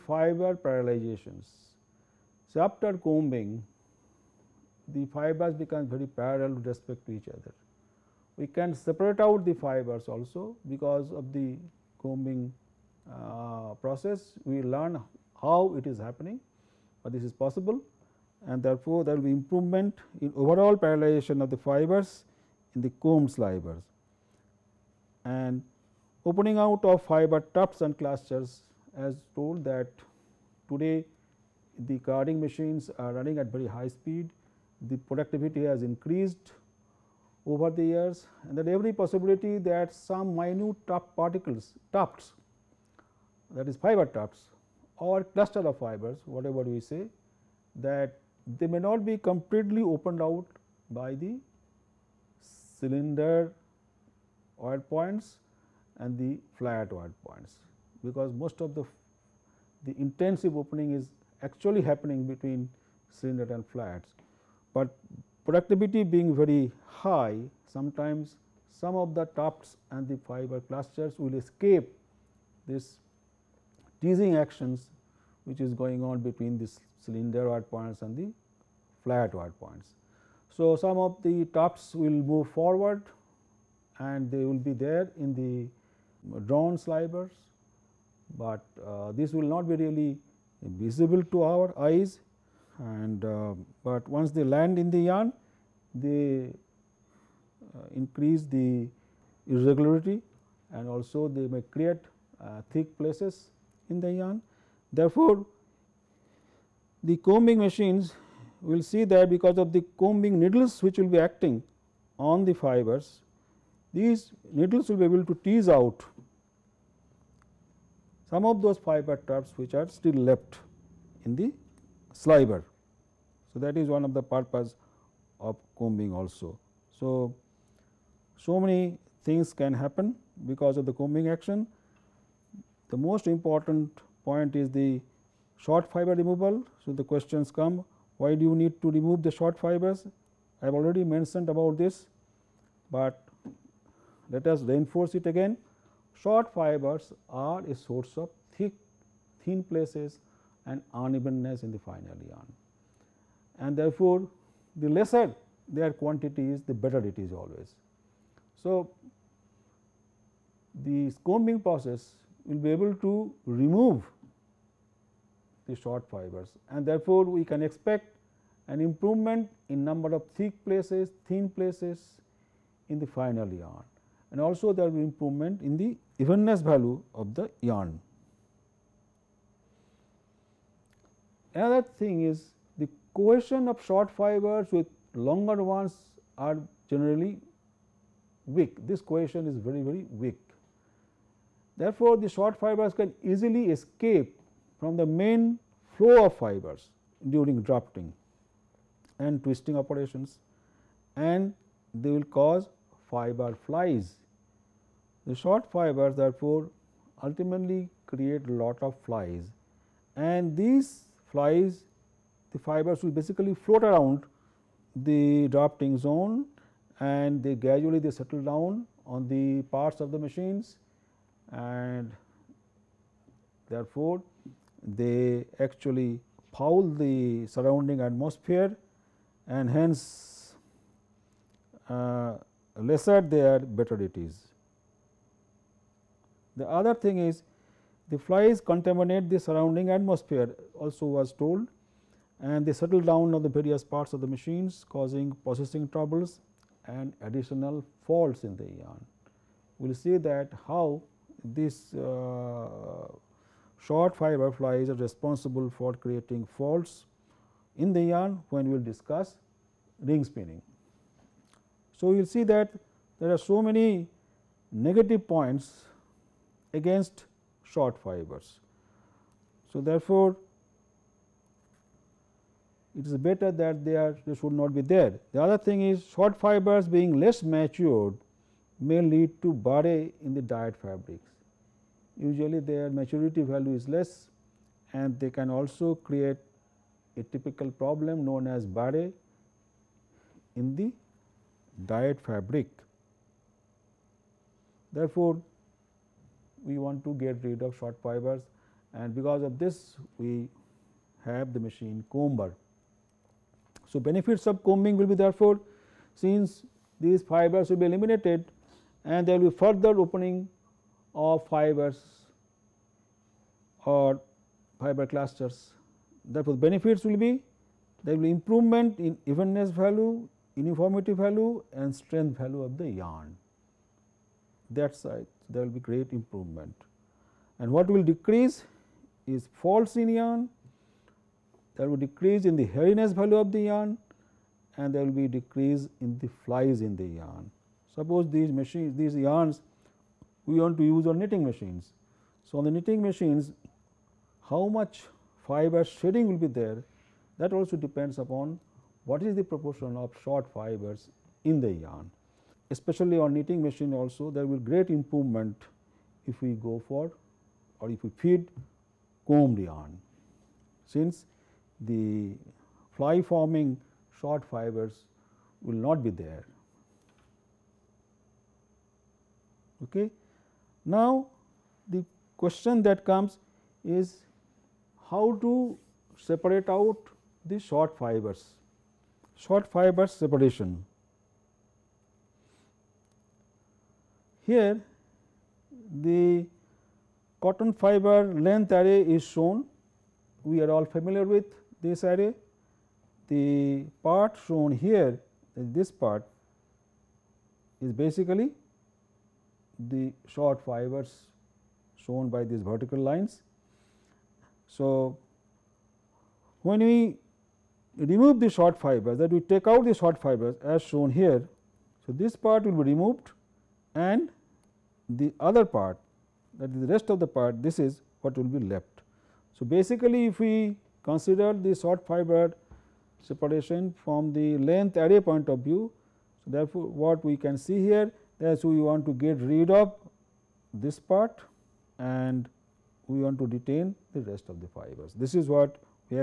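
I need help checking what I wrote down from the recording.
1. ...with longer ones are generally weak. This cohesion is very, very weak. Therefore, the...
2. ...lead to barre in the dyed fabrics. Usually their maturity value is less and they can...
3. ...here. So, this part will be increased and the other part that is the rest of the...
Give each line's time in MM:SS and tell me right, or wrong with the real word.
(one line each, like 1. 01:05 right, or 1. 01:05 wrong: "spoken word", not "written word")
1. 03:04 right
2. 04:39 right
3. 06:51 wrong: "removed", not "increased".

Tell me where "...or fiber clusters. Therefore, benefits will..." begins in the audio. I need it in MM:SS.
05:13.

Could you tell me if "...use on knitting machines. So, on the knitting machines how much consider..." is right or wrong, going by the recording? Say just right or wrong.
wrong.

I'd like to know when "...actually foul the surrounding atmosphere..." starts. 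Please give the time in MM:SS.
03:45.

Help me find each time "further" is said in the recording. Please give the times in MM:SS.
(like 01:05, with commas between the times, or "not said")
05:09.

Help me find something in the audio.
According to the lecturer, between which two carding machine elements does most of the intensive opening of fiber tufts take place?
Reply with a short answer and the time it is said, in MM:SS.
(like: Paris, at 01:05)
Cylinder and flats, at 01:02.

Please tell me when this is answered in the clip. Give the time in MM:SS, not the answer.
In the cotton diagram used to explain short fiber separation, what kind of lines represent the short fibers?
06:42.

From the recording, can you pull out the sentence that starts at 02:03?
So, that is one of the purpose of combing also.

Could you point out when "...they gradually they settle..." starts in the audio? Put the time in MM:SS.
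03:37.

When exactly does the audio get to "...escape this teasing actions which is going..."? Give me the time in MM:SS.
01:11.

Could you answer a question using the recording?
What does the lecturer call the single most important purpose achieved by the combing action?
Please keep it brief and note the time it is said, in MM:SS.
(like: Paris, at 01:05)
Short fiber removal, at 02:15.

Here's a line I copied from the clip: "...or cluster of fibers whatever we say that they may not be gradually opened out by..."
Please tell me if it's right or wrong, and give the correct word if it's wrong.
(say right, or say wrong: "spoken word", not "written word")
wrong: "completely", not "gradually".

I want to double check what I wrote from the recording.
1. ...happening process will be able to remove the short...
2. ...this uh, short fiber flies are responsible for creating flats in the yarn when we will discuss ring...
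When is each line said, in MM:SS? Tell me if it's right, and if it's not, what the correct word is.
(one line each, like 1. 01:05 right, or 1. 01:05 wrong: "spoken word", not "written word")
1. 02:41 wrong: "combing", not "happening"
2. 04:11 wrong: "faults", not "flats".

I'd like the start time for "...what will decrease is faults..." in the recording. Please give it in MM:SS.
05:27.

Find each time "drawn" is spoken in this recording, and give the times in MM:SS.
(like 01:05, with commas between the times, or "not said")
01:26.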